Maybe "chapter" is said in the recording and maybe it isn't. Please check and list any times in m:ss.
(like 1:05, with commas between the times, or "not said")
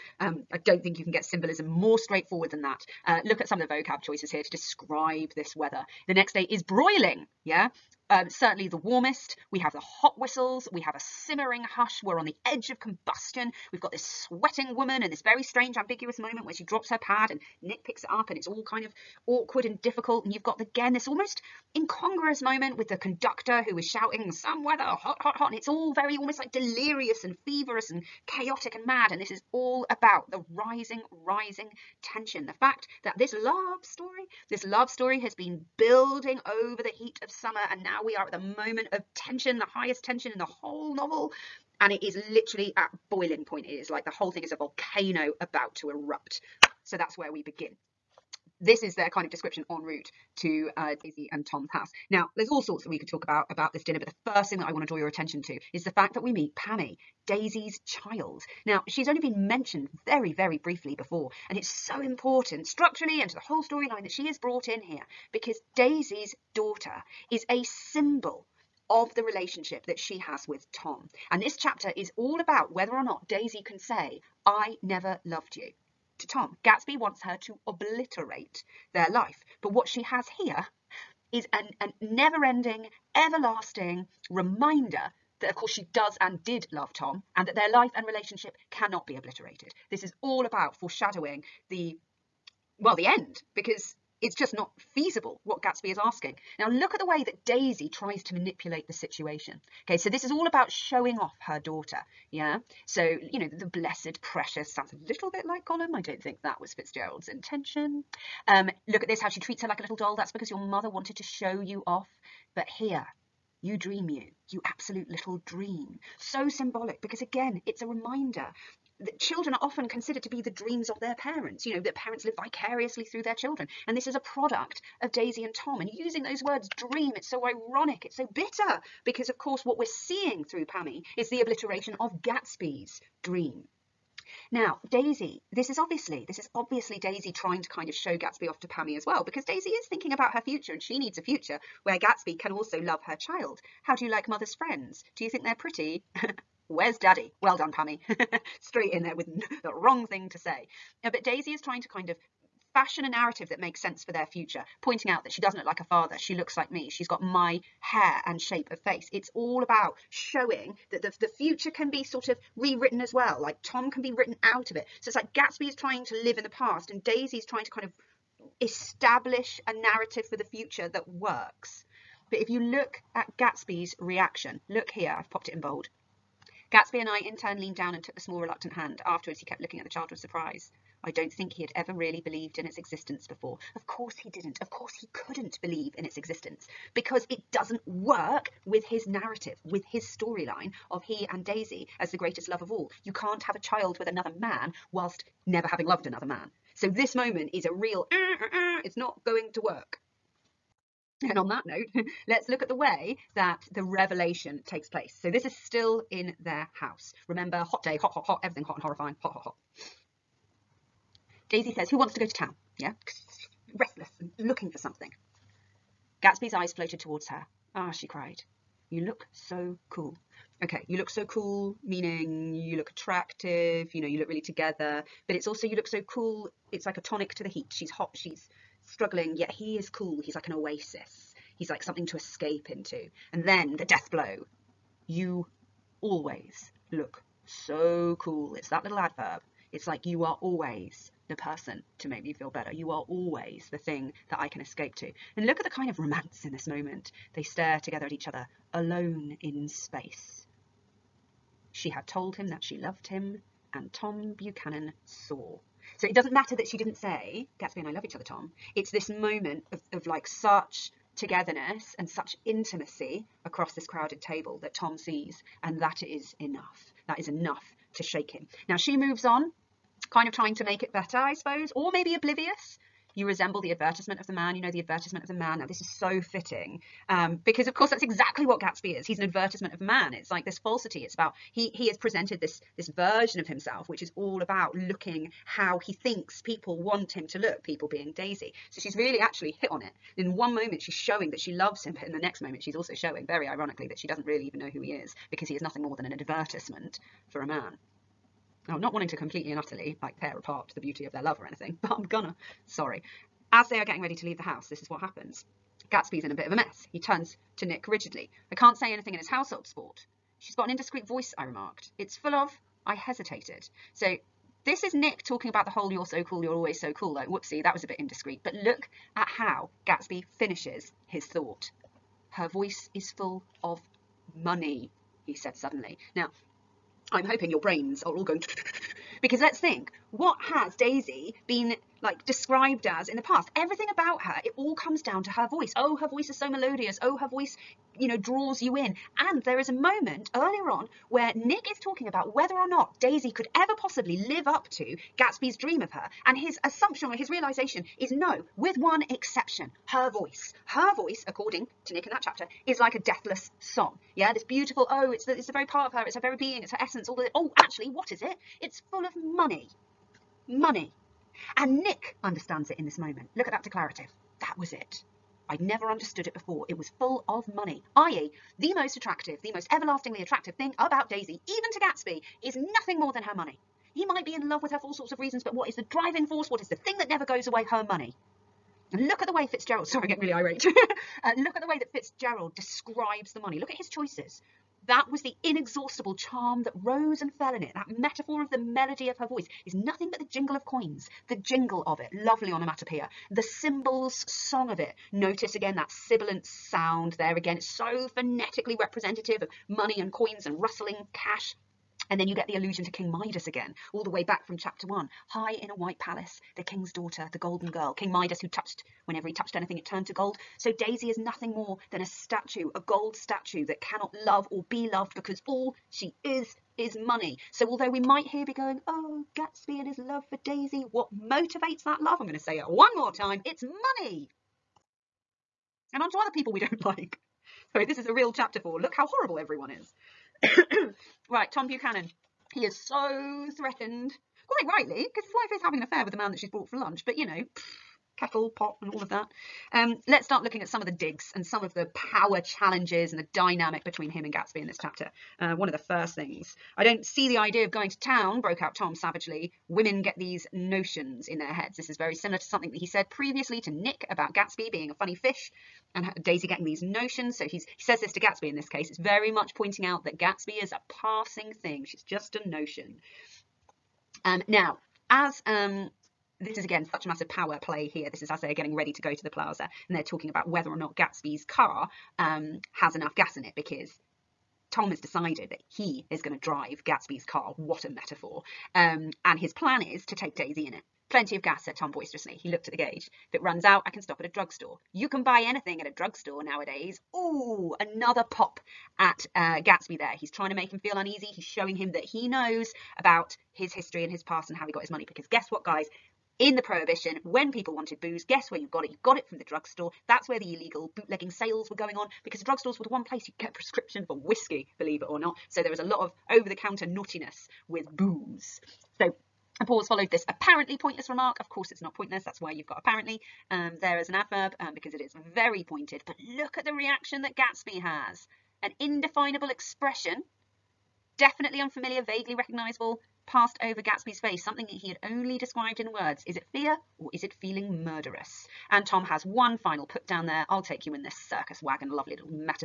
1:11, 5:52, 6:44, 7:08, 7:24.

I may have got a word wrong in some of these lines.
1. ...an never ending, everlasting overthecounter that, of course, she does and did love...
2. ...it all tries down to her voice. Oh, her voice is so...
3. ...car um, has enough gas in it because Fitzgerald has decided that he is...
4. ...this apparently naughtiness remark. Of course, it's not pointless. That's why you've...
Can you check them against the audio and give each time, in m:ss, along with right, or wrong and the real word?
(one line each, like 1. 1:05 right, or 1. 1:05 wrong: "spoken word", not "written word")
1. 1:21 wrong: "reminder", not "overthecounter"
2. 5:34 wrong: "comes", not "tries"
3. 7:51 wrong: "Tom", not "Fitzgerald"
4. 8:30 wrong: "pointless", not "naughtiness".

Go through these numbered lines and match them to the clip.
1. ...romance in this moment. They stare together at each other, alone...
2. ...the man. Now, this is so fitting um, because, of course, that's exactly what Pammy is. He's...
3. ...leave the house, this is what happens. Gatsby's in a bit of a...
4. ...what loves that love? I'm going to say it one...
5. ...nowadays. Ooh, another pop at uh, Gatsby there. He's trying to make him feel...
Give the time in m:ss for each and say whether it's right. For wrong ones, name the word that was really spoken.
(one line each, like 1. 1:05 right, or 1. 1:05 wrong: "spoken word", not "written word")
1. 4:05 right
2. 4:35 wrong: "Gatsby", not "Pammy"
3. 5:04 right
4. 7:00 wrong: "motivates", not "loves"
5. 8:06 right.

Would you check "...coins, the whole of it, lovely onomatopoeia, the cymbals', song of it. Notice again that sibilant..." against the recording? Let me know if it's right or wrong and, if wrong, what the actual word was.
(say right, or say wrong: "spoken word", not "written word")
wrong: "jingle", not "whole".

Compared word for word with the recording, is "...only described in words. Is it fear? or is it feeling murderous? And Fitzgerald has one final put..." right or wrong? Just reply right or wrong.
wrong.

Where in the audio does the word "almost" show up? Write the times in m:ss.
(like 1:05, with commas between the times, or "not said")
0:21, 0:26.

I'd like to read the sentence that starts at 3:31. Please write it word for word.
Daisy says, who wants to go to town?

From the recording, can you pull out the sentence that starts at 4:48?
So she's really actually hit on it.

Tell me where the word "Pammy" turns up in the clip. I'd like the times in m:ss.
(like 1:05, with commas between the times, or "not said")
0:56, 2:10, 2:18, 2:27.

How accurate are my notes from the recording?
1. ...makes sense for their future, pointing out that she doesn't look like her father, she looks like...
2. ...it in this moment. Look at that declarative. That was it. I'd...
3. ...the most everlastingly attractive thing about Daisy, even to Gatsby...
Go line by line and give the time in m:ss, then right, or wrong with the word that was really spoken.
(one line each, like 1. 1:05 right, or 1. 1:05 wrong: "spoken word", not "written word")
1. 2:33 right
2. 6:02 right
3. 6:09 right.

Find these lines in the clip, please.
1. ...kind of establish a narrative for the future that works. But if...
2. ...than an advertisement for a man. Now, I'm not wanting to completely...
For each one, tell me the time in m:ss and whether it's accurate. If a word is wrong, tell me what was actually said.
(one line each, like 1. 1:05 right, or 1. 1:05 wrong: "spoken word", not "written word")
1. 2:47 right
2. 4:55 right.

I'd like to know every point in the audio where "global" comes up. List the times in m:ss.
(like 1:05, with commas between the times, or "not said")
not said.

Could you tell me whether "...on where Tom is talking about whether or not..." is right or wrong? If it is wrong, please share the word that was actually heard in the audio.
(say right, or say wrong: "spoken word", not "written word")
wrong: "Nick", not "Tom".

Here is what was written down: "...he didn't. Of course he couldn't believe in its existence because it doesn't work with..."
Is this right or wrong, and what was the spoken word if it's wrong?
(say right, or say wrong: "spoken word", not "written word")
right.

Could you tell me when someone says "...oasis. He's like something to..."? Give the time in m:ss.
3:50.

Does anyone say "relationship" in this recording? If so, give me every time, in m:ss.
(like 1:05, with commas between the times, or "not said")
1:09, 1:28.